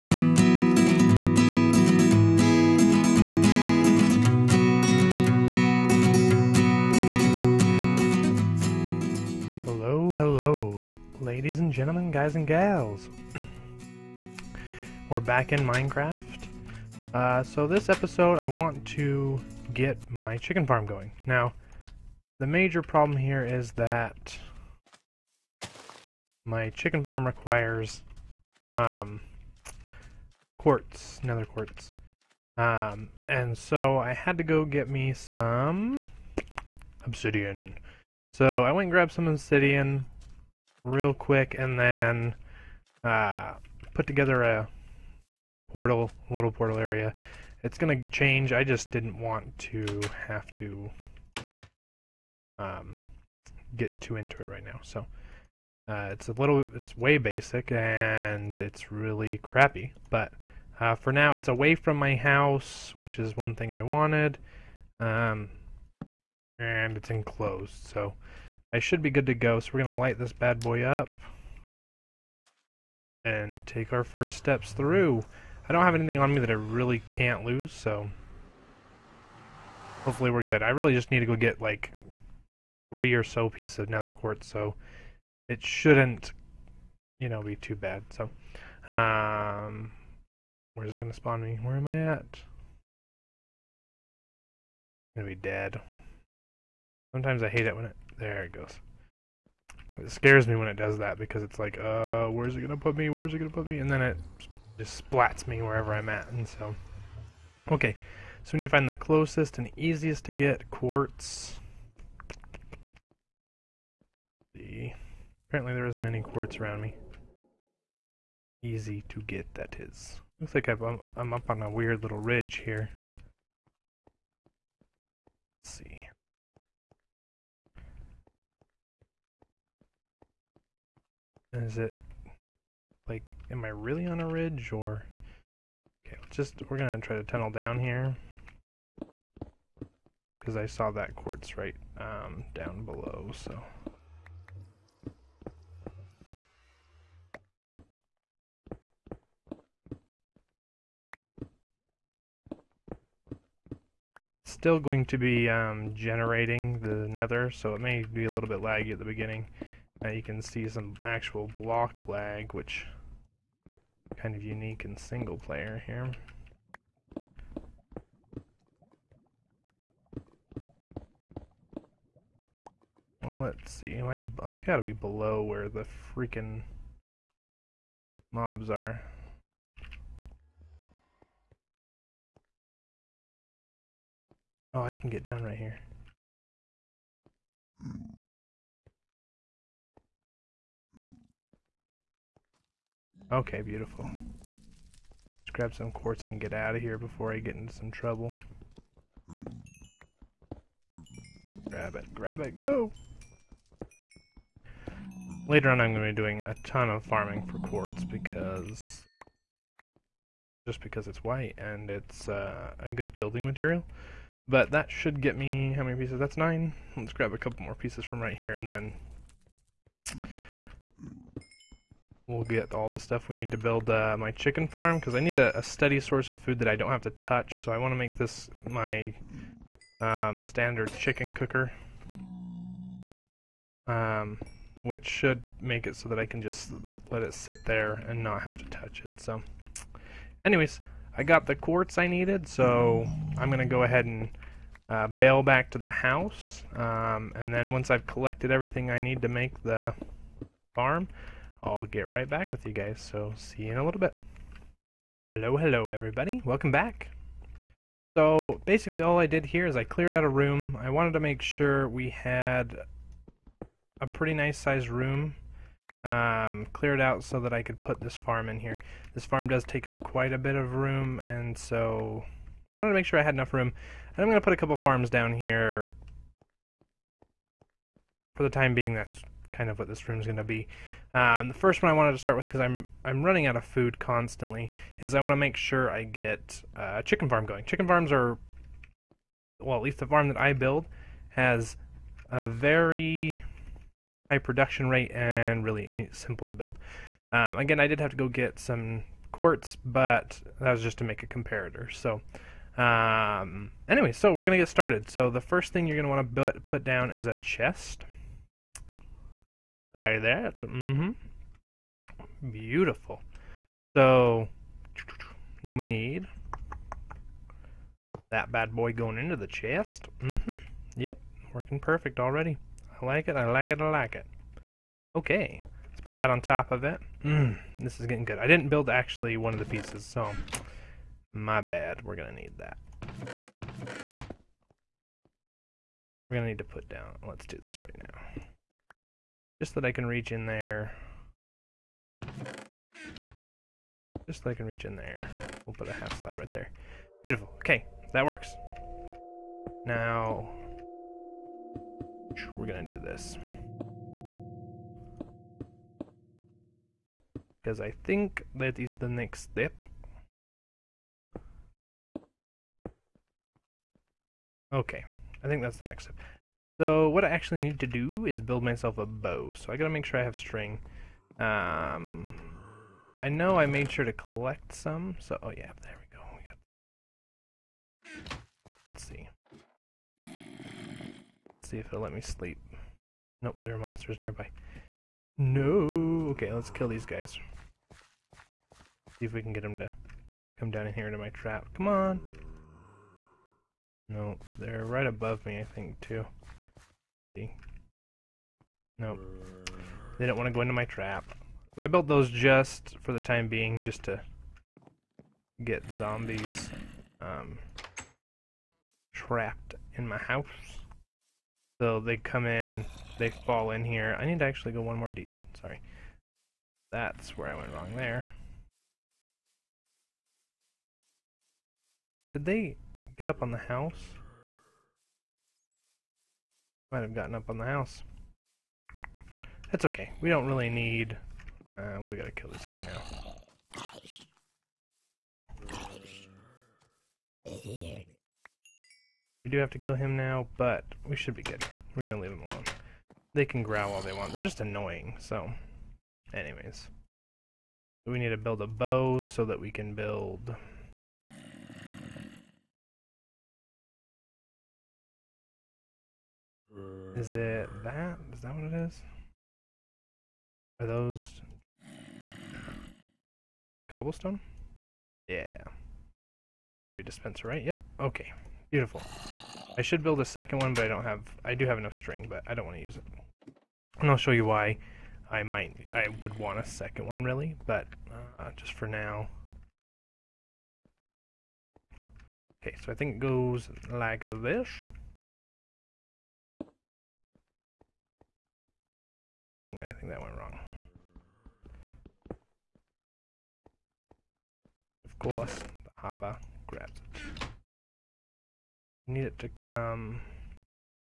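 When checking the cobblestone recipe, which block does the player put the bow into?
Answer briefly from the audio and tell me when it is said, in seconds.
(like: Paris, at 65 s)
Dispenser, at 467 s.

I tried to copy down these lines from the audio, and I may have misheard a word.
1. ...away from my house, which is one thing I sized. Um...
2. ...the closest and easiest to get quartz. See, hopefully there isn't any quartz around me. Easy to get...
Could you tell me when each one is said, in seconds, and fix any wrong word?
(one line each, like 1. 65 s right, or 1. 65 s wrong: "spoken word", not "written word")
1. 61 s wrong: "wanted", not "sized"
2. 108 s wrong: "apparently", not "hopefully".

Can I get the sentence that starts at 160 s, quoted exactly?
Now you can see some actual block lag, which kind of unique in single player here.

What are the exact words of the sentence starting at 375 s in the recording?
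So oh yeah, there we go.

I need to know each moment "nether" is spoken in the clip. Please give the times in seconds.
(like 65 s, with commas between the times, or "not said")
31 s, 83 s, 157 s.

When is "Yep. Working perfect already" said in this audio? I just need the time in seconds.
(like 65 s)
320 s.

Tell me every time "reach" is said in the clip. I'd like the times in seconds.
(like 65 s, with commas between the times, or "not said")
340 s, 344 s.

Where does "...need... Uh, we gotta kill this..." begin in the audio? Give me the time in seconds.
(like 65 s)
430 s.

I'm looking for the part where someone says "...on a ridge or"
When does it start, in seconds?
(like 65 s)
134 s.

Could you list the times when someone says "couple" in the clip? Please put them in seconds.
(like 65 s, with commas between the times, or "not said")
217 s, 274 s.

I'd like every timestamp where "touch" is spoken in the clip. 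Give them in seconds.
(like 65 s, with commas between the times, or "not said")
227 s, 238 s.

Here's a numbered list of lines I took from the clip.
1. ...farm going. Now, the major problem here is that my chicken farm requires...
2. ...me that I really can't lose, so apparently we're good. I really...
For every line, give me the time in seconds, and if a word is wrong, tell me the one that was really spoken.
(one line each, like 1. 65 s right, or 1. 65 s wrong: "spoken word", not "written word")
1. 20 s right
2. 76 s wrong: "hopefully", not "apparently".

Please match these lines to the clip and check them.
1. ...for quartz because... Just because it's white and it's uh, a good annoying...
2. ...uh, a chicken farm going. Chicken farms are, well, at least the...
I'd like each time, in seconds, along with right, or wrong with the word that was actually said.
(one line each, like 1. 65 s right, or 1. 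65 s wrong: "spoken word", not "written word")
1. 207 s wrong: "building", not "annoying"
2. 286 s right.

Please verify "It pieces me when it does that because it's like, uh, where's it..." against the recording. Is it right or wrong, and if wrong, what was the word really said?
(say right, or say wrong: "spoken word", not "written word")
wrong: "scares", not "pieces".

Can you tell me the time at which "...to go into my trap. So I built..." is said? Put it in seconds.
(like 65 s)
400 s.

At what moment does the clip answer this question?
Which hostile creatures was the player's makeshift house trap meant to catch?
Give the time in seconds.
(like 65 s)
405 s.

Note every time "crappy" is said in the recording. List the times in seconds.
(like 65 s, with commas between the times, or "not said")
59 s.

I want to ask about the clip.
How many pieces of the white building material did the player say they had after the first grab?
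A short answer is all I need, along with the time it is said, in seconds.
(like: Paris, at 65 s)
9, at 216 s.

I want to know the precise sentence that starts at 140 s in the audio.
Because I saw that quartz right um, down below, so.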